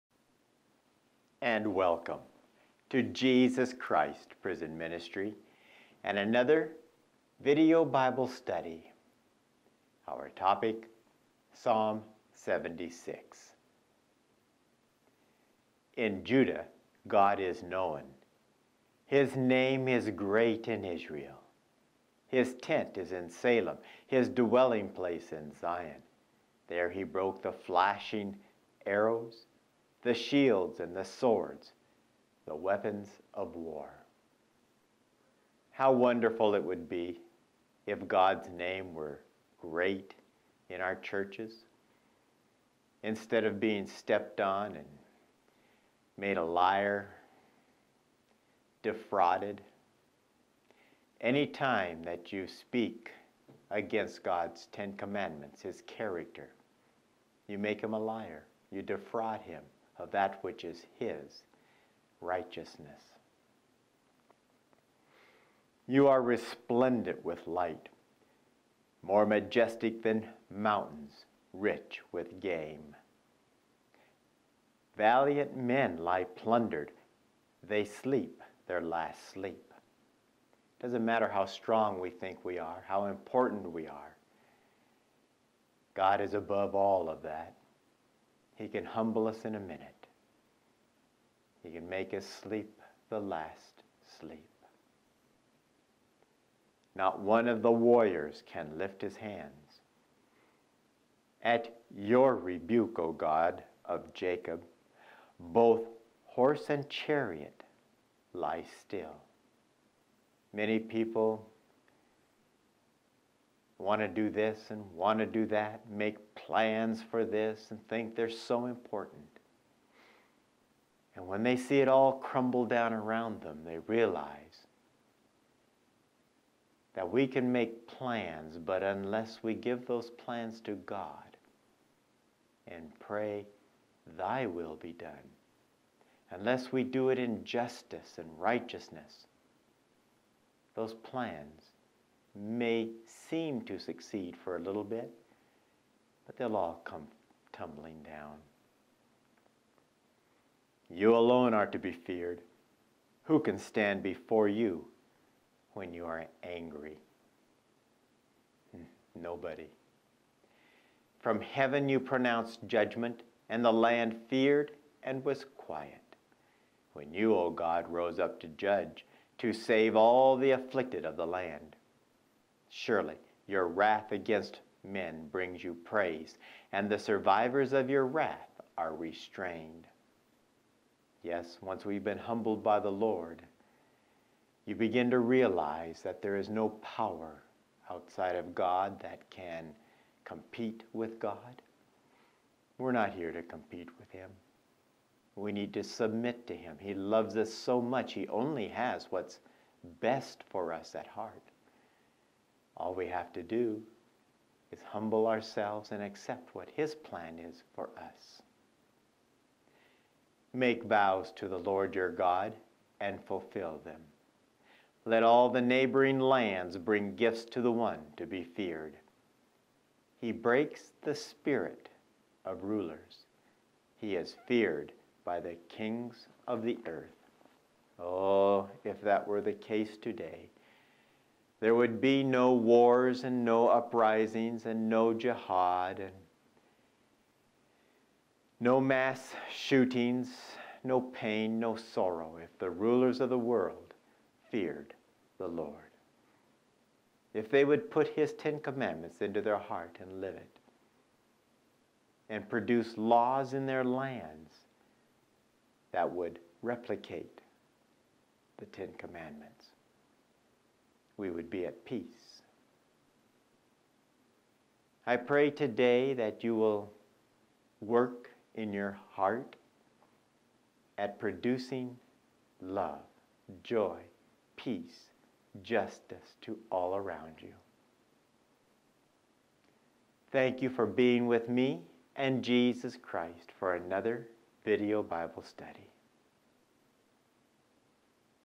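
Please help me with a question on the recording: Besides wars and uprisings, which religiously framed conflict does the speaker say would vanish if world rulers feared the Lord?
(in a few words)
jihad.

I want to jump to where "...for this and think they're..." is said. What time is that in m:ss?
1:57.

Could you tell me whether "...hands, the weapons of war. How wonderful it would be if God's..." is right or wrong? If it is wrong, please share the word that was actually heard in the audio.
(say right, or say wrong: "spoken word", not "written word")
wrong: "swords", not "hands".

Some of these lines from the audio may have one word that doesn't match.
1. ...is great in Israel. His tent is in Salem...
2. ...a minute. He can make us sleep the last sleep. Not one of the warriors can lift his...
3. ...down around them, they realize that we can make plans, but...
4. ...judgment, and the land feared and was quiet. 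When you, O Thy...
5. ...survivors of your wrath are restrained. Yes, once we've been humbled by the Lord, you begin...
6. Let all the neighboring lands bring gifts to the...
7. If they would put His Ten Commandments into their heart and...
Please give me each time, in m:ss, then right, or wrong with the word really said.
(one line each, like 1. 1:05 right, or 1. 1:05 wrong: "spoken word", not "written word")
1. 0:19 right
2. 1:29 right
3. 2:02 right
4. 2:42 wrong: "God", not "Thy"
5. 2:56 right
6. 3:35 right
7. 4:07 right.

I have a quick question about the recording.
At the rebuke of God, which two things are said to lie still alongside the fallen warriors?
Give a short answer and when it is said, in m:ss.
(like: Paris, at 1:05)
horse and chariot, at 1:46.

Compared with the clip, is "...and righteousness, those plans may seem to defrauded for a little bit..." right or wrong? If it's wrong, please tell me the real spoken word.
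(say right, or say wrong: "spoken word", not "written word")
wrong: "succeed", not "defrauded".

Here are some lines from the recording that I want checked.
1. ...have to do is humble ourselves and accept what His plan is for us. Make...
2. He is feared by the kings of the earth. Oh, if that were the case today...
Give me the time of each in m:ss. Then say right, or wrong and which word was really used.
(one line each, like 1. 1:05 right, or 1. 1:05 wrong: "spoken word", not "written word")
1. 3:23 right
2. 3:43 right.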